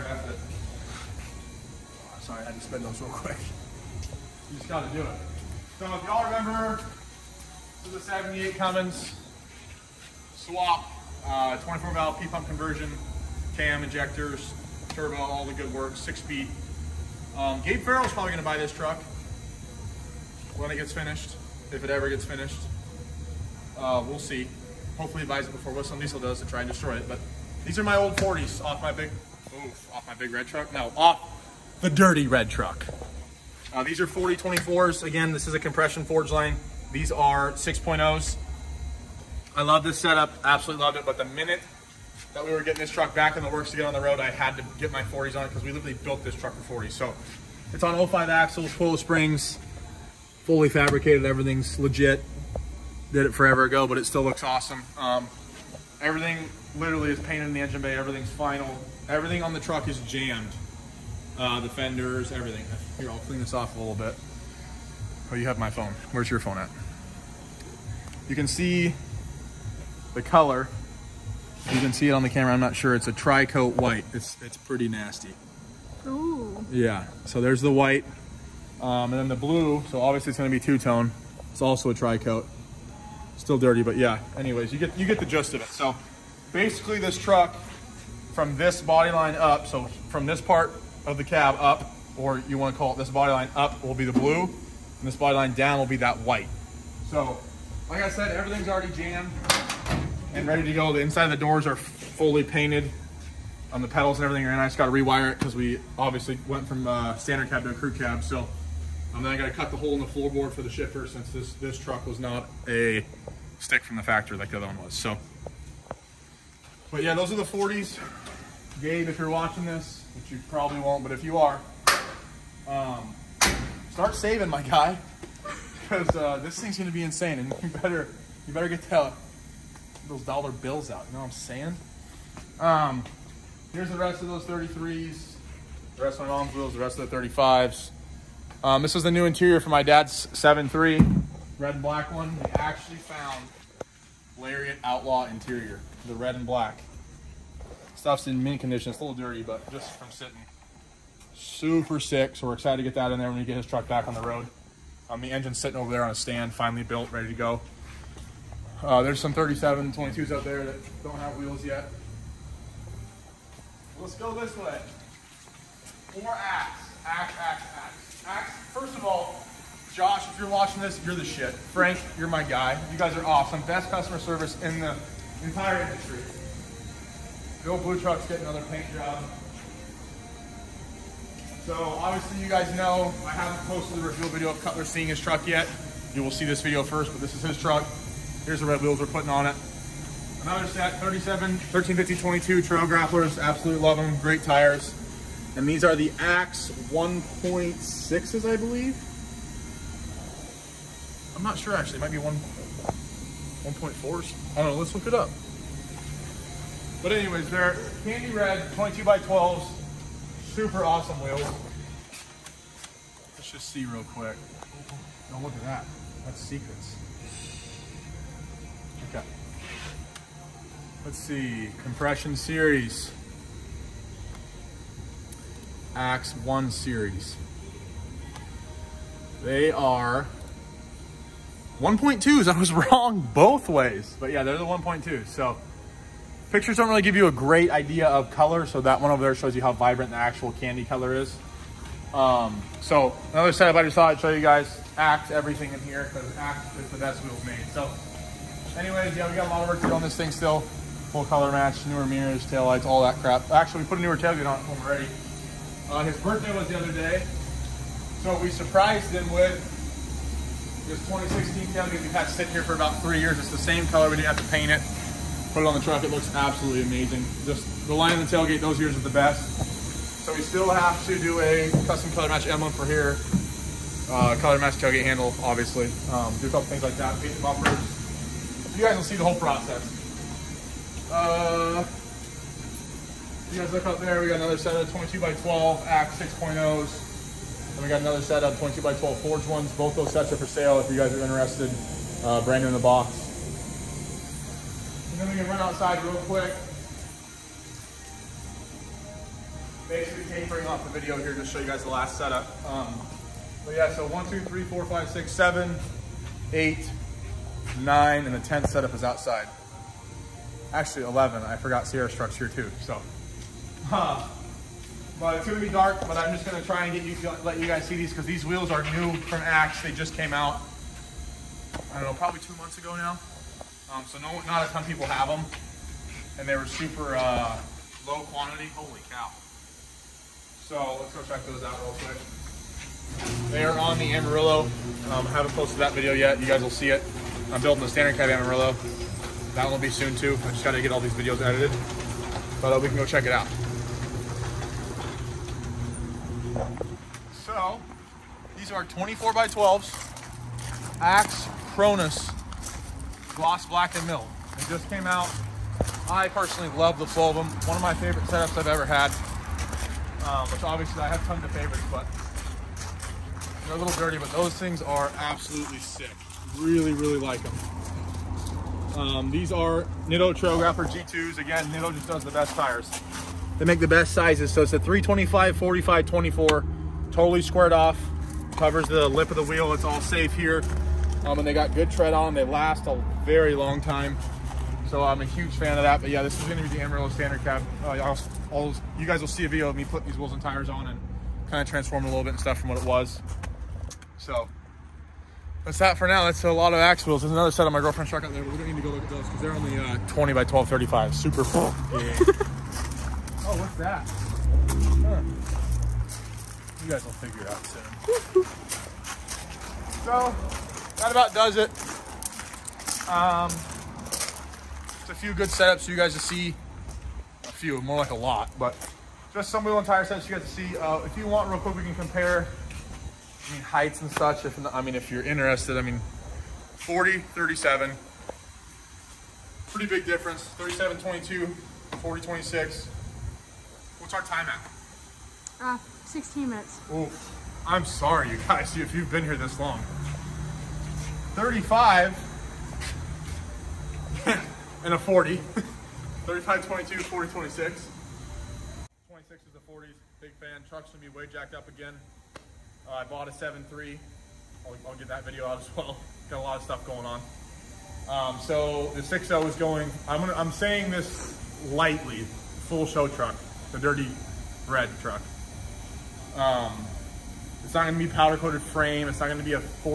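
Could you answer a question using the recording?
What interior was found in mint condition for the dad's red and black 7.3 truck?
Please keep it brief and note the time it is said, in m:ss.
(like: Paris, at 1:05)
Lariat Outlaw, at 2:24.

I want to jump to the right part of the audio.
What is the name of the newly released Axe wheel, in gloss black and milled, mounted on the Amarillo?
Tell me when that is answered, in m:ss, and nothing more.
5:51.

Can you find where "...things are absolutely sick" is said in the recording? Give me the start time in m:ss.
6:04.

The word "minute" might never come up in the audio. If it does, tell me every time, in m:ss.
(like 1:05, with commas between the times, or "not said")
0:41, 7:16.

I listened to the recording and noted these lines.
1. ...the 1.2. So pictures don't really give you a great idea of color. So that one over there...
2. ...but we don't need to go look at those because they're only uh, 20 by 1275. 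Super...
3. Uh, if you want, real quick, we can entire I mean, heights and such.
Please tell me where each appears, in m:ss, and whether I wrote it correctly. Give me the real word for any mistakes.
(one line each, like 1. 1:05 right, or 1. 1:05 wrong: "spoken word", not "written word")
1. 3:54 right
2. 6:38 wrong: "1235", not "1275"
3. 7:00 wrong: "compare", not "entire".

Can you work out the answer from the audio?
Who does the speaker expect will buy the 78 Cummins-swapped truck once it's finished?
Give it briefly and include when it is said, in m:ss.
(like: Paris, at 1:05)
Gabe Farrell, at 0:17.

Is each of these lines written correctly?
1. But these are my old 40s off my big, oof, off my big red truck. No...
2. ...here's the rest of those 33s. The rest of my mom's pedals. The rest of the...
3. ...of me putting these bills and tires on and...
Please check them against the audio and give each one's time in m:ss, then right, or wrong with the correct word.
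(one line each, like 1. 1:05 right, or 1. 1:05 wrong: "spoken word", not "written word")
1. 0:27 right
2. 2:13 wrong: "wheels", not "pedals"
3. 6:29 wrong: "wheels", not "bills".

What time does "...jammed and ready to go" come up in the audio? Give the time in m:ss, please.
1:38.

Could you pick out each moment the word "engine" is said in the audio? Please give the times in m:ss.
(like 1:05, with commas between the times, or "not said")
0:57, 2:35.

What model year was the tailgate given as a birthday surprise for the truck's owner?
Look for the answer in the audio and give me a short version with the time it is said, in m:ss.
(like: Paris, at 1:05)
2016, at 4:21.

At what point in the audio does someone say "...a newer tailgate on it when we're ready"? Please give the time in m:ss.
4:13.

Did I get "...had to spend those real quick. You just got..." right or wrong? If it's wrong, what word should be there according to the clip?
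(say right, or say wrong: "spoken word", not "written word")
right.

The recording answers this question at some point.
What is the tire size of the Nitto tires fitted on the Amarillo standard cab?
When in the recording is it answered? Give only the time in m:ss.
6:14.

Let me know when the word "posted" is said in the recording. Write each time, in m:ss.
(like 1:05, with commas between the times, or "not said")
3:03, 5:35.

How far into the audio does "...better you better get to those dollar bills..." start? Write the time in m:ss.
2:07.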